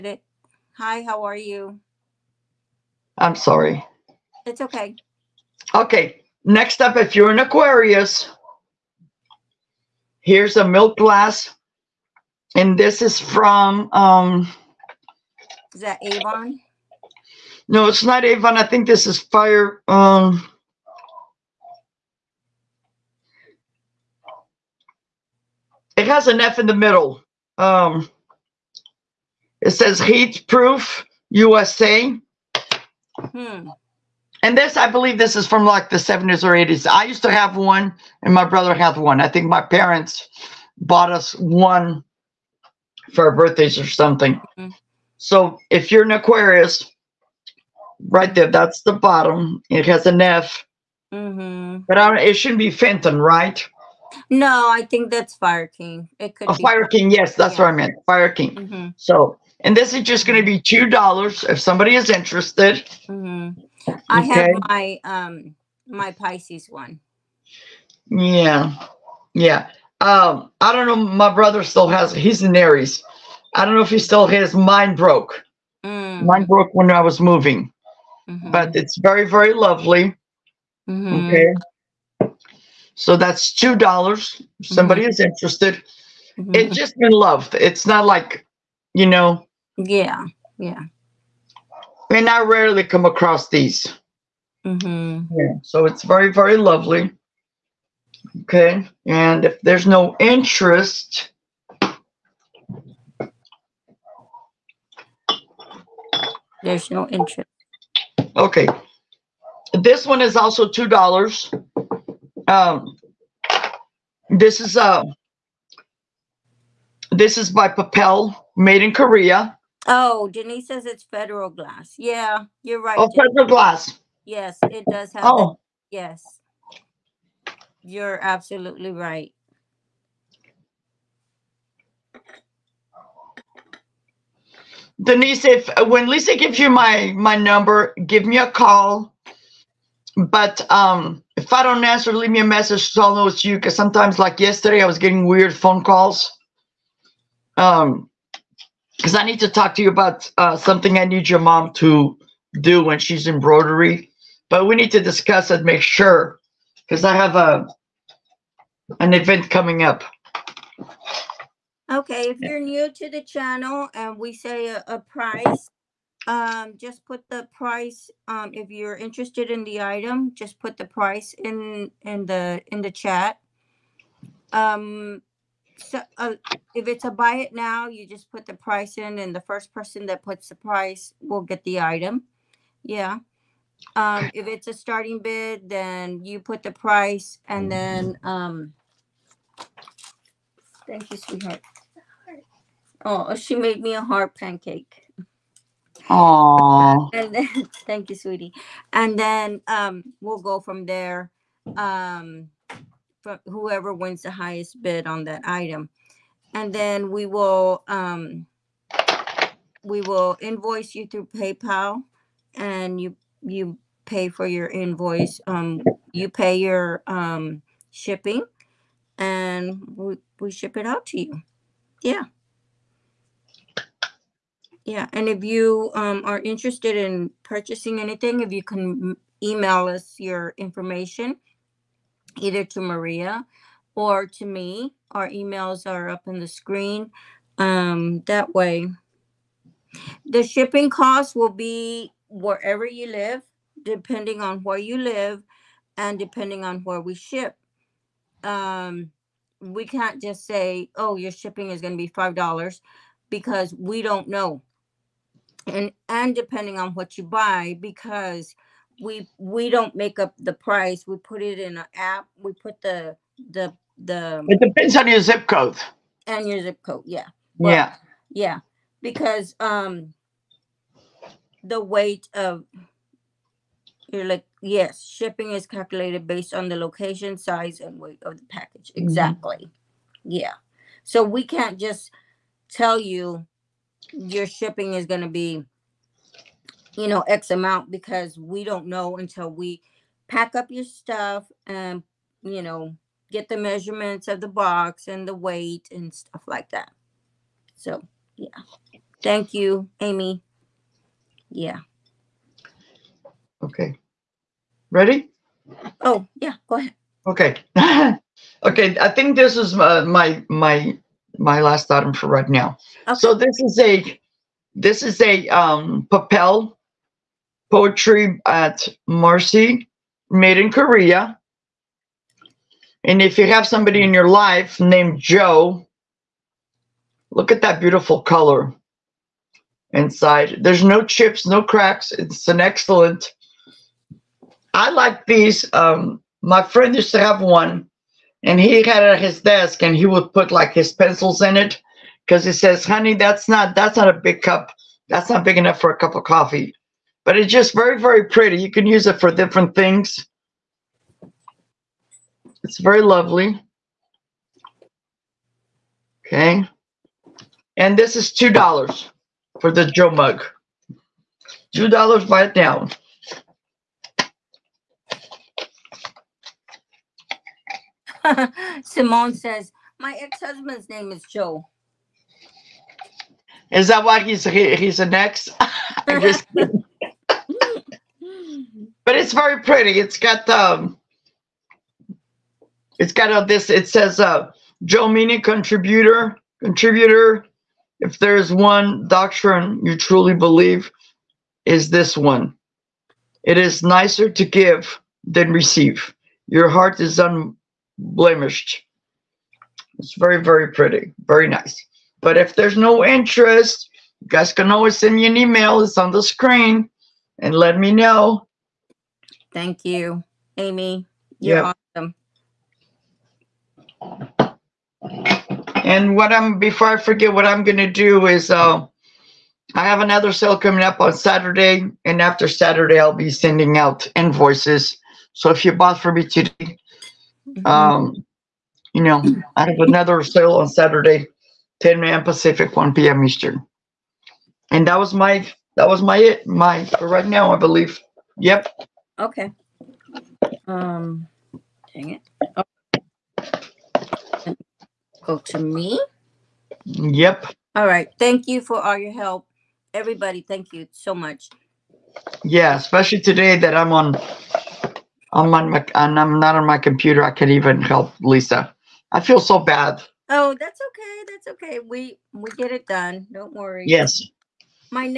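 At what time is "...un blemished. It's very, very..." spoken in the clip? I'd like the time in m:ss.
6:37.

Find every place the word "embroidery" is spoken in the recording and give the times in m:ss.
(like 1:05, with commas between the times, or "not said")
2:33.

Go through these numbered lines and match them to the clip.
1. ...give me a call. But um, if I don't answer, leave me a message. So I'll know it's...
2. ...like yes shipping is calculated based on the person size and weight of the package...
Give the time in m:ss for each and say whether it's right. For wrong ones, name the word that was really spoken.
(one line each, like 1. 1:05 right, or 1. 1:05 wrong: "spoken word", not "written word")
1. 2:18 right
2. 4:34 wrong: "location", not "person".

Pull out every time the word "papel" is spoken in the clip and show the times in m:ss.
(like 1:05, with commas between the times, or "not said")
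1:57, 5:16.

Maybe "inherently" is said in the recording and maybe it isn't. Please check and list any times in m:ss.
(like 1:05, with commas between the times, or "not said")
not said.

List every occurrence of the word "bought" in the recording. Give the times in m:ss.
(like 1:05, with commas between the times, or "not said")
0:40, 7:05.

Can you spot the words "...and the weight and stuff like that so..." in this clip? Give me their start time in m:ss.
4:55.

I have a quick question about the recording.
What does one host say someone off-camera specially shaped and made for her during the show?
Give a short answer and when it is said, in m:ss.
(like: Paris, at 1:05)
heart pancake, at 3:14.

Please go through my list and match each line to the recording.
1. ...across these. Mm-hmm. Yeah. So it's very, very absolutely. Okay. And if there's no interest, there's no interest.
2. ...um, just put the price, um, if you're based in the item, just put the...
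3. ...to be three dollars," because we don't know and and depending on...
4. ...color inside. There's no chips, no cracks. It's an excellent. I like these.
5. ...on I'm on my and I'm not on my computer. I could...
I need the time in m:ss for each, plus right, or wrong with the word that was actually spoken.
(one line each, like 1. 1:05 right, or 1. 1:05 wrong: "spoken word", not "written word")
1. 1:33 wrong: "lovely", not "absolutely"
2. 2:46 wrong: "interested", not "based"
3. 4:11 wrong: "five", not "three"
4. 5:28 right
5. 7:33 right.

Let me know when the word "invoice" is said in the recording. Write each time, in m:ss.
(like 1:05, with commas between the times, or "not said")
3:30, 3:34, 7:04.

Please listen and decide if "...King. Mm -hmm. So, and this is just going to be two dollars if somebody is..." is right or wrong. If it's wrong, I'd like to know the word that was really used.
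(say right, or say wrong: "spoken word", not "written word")
right.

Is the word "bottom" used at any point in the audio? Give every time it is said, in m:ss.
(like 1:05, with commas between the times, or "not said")
0:48.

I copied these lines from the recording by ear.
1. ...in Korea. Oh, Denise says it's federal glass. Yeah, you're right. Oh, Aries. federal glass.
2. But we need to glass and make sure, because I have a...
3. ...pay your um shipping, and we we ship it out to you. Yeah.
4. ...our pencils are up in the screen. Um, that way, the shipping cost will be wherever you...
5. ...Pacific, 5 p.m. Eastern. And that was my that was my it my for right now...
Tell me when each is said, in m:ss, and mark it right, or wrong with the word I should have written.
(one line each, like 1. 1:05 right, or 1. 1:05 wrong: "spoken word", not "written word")
1. 1:58 wrong: "Denise", not "Aries"
2. 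2:34 wrong: "discuss", not "glass"
3. 3:36 right
4. 3:55 wrong: "emails", not "pencils"
5. 7:12 wrong: "1", not "5".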